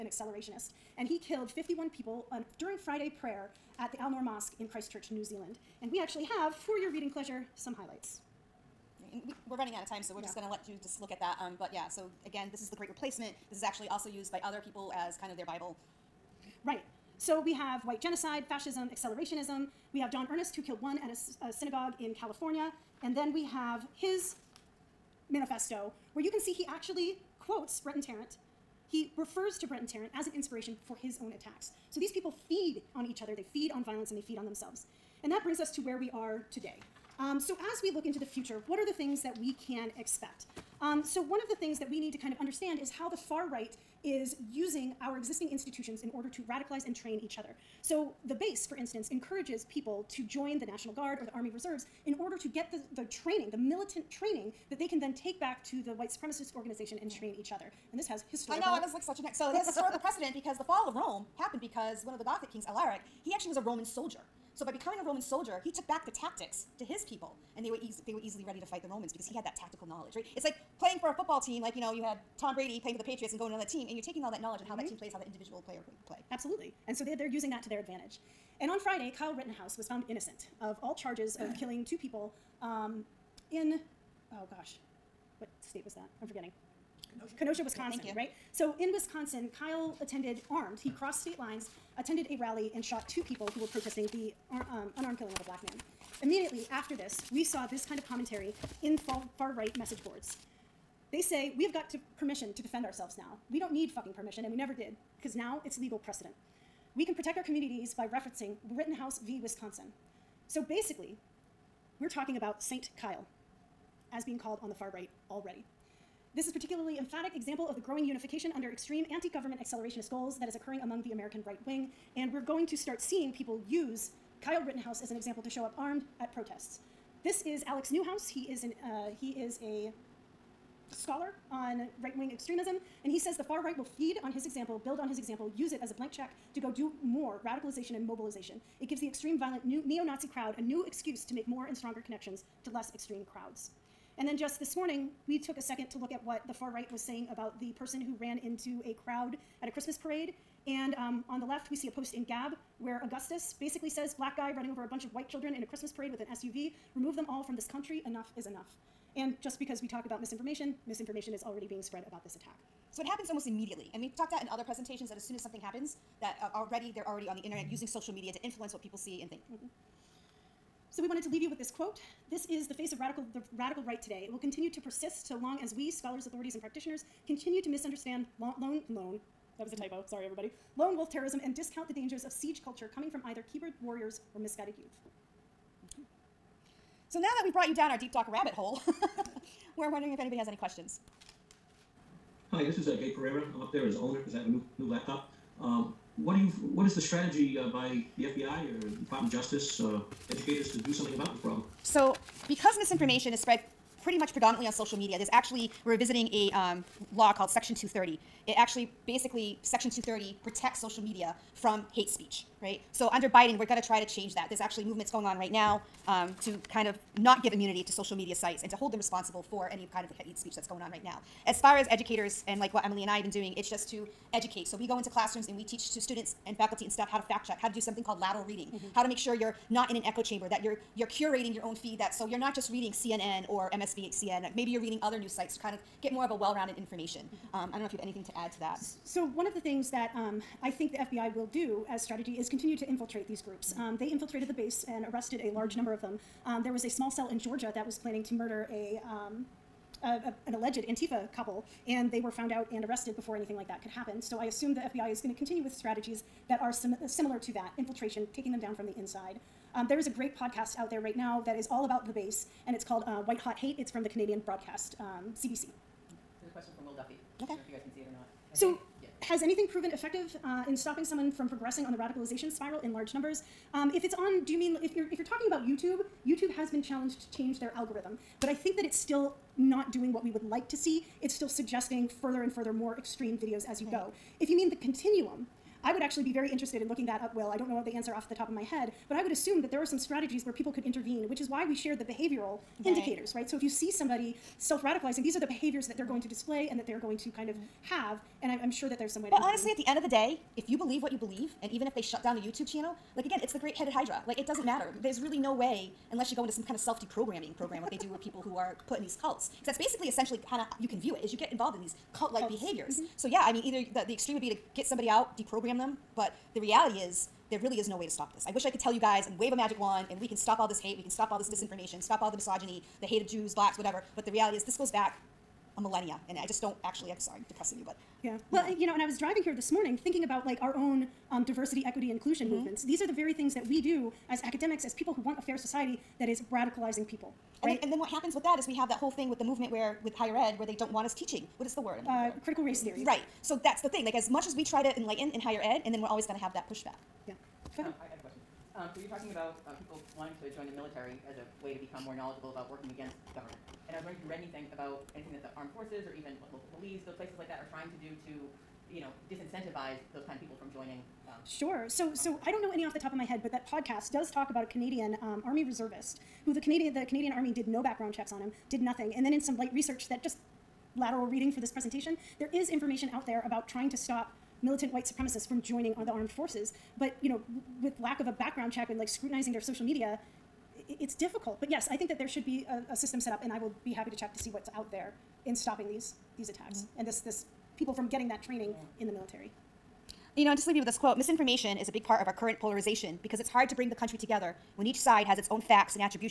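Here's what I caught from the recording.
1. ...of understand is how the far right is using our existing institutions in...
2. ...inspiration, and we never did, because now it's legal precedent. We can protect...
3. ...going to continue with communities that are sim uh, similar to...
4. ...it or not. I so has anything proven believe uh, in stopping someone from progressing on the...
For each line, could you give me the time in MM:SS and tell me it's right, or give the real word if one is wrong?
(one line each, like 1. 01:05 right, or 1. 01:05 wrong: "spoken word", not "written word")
1. 00:42 right
2. 01:44 wrong: "permission", not "inspiration"
3. 04:15 wrong: "strategies", not "communities"
4. 04:27 wrong: "effective", not "believe".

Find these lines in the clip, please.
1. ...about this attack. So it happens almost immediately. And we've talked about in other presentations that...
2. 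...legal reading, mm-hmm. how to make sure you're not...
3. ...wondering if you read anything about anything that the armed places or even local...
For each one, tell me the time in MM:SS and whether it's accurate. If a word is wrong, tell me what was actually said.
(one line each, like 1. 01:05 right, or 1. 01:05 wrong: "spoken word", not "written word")
1. 02:42 right
2. 03:48 wrong: "lateral", not "legal"
3. 05:54 wrong: "forces", not "places".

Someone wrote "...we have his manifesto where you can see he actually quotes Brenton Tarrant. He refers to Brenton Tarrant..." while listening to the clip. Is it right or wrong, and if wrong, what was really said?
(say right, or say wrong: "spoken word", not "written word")
right.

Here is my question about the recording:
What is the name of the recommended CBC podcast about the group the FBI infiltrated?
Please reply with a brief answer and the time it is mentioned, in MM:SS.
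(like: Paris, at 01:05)
White Hot Hate, at 04:23.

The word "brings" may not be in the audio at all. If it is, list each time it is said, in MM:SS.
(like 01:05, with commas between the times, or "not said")
00:35, 06:33.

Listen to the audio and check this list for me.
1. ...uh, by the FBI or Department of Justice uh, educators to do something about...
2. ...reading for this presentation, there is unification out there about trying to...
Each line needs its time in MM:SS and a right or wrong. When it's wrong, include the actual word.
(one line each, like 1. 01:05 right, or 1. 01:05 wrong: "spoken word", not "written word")
1. 03:17 right
2. 06:11 wrong: "information", not "unification".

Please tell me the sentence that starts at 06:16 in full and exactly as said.
But you know, with lack of a background check and like scrutinizing their social media, it's difficult.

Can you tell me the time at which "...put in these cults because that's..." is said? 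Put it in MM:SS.
05:08.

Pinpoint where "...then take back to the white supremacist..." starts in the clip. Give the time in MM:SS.
00:54.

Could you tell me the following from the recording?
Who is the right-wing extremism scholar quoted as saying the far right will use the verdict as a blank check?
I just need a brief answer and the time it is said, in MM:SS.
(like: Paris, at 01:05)
Alex Newhouse, at 02:07.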